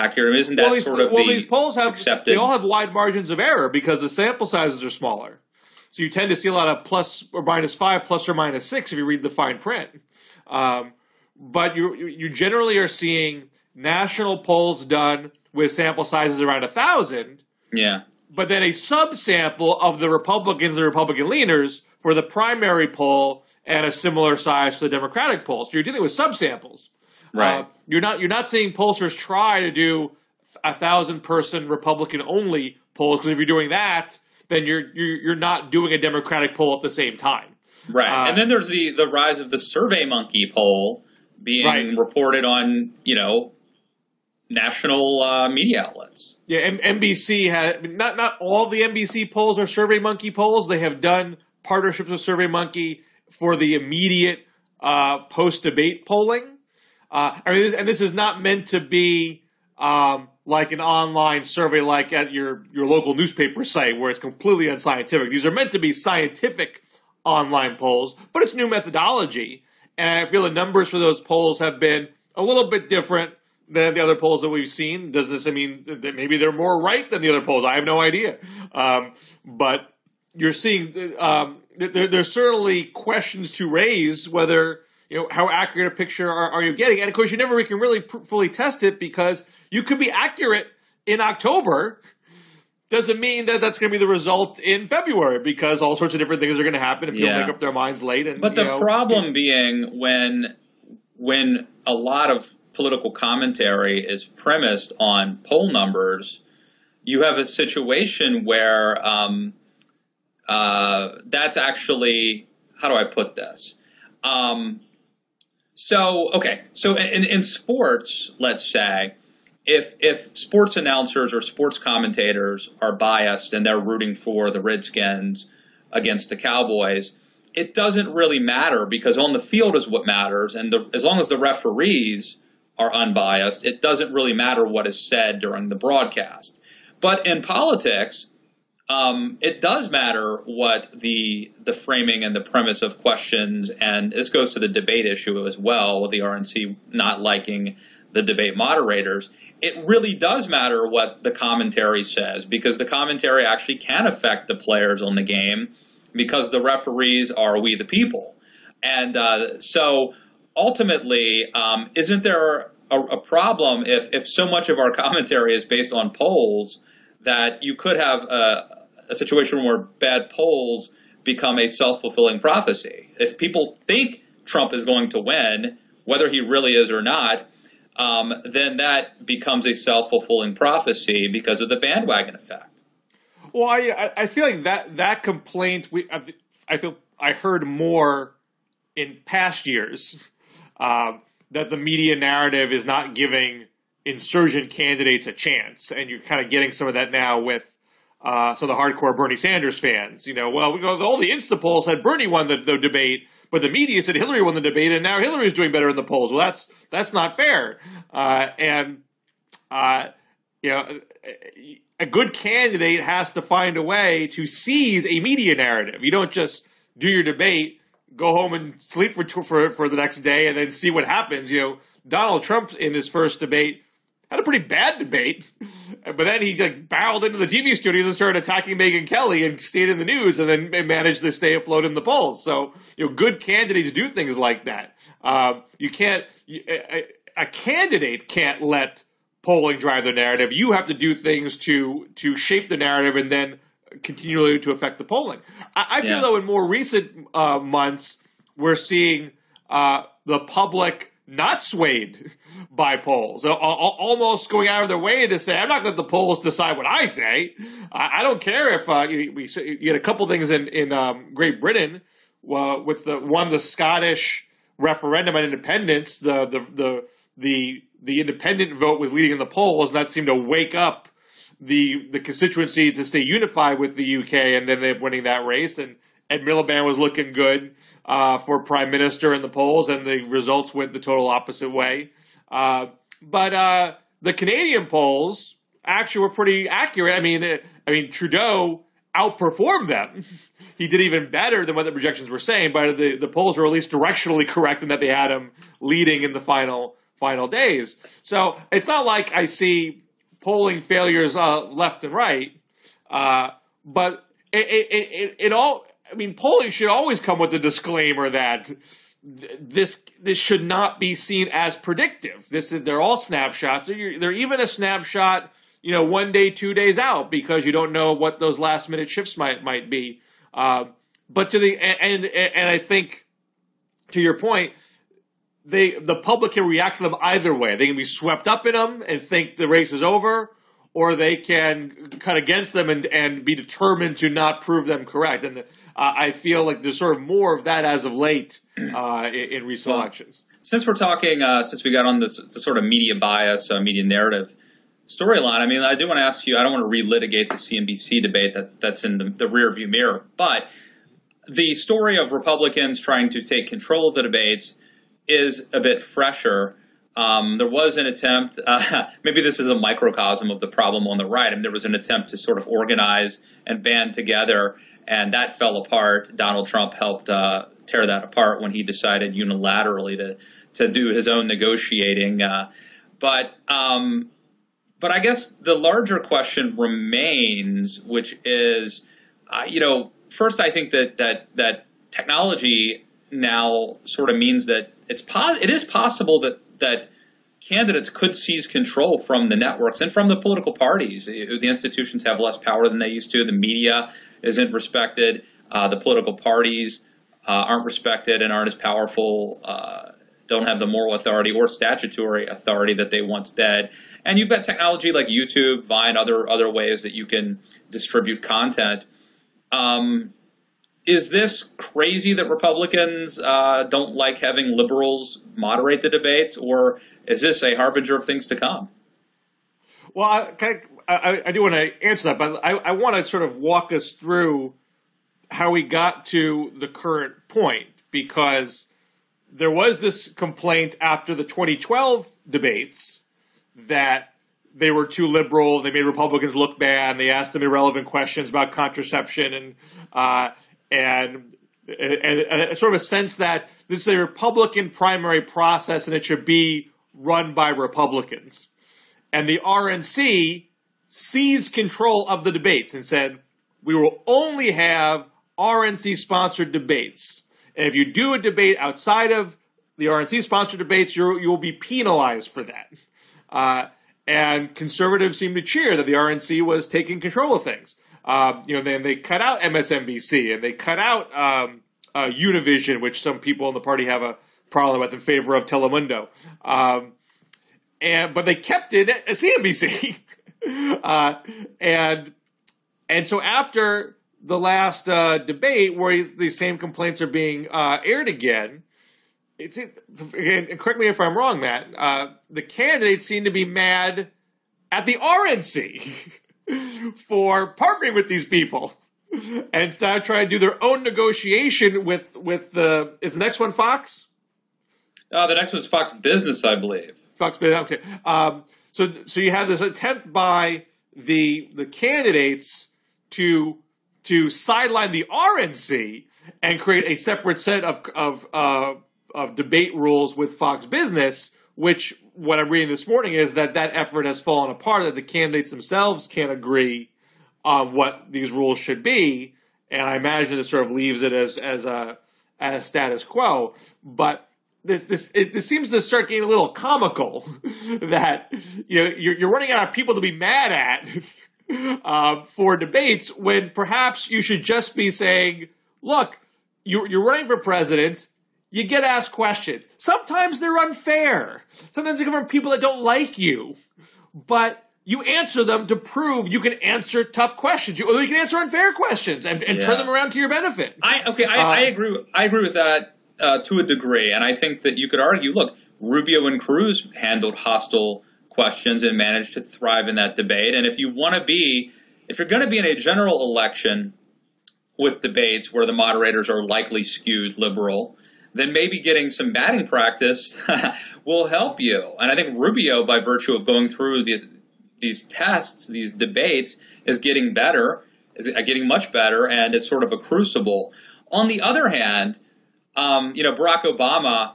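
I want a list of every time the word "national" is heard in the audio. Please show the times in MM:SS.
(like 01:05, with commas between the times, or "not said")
00:13, 00:44.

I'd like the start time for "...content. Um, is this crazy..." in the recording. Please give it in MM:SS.
06:48.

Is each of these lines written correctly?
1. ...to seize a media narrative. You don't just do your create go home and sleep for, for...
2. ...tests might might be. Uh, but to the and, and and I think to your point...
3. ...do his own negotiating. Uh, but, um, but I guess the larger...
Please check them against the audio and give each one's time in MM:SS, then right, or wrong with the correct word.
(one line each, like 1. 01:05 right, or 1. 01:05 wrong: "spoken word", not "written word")
1. 03:34 wrong: "debate", not "create"
2. 05:19 wrong: "shifts", not "tests"
3. 06:10 right.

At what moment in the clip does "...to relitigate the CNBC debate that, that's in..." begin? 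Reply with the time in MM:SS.
05:46.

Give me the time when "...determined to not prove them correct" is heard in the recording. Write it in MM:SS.
05:33.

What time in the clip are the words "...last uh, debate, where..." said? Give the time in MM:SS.
08:04.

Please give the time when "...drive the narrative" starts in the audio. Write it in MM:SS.
03:59.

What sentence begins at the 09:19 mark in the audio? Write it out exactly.
turn them around to your benefit.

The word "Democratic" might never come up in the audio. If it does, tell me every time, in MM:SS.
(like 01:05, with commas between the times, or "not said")
00:24, 00:36.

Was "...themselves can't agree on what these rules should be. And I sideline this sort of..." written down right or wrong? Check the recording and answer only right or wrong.
wrong.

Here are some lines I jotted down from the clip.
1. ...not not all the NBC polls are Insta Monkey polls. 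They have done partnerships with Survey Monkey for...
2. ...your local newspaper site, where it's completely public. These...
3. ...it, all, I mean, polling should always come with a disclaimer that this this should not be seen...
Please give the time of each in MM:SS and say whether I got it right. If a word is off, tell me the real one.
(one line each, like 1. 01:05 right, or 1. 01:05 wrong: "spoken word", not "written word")
1. 00:47 wrong: "Survey", not "Insta"
2. 01:02 wrong: "unscientific", not "public"
3. 05:05 right.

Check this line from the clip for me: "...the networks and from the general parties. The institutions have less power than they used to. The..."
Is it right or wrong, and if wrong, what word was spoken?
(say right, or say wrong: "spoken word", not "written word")
wrong: "political", not "general".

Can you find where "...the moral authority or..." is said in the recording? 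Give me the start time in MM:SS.
06:40.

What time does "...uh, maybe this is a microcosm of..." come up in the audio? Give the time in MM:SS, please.
05:58.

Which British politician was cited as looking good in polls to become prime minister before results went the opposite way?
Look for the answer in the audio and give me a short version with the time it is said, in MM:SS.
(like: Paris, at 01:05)
Ed Miliband, at 04:36.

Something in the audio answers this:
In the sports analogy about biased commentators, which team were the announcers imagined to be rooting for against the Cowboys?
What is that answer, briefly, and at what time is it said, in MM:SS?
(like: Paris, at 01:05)
Redskins, at 02:04.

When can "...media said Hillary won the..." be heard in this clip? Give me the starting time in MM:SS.
03:23.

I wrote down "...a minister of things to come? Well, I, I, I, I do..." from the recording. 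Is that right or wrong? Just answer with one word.
wrong.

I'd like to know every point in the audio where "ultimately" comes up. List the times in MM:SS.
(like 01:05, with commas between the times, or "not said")
02:40.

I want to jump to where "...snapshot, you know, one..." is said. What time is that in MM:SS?
05:14.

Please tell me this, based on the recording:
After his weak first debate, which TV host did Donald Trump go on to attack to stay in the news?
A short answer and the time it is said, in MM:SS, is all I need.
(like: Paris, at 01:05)
Megyn Kelly, at 03:48.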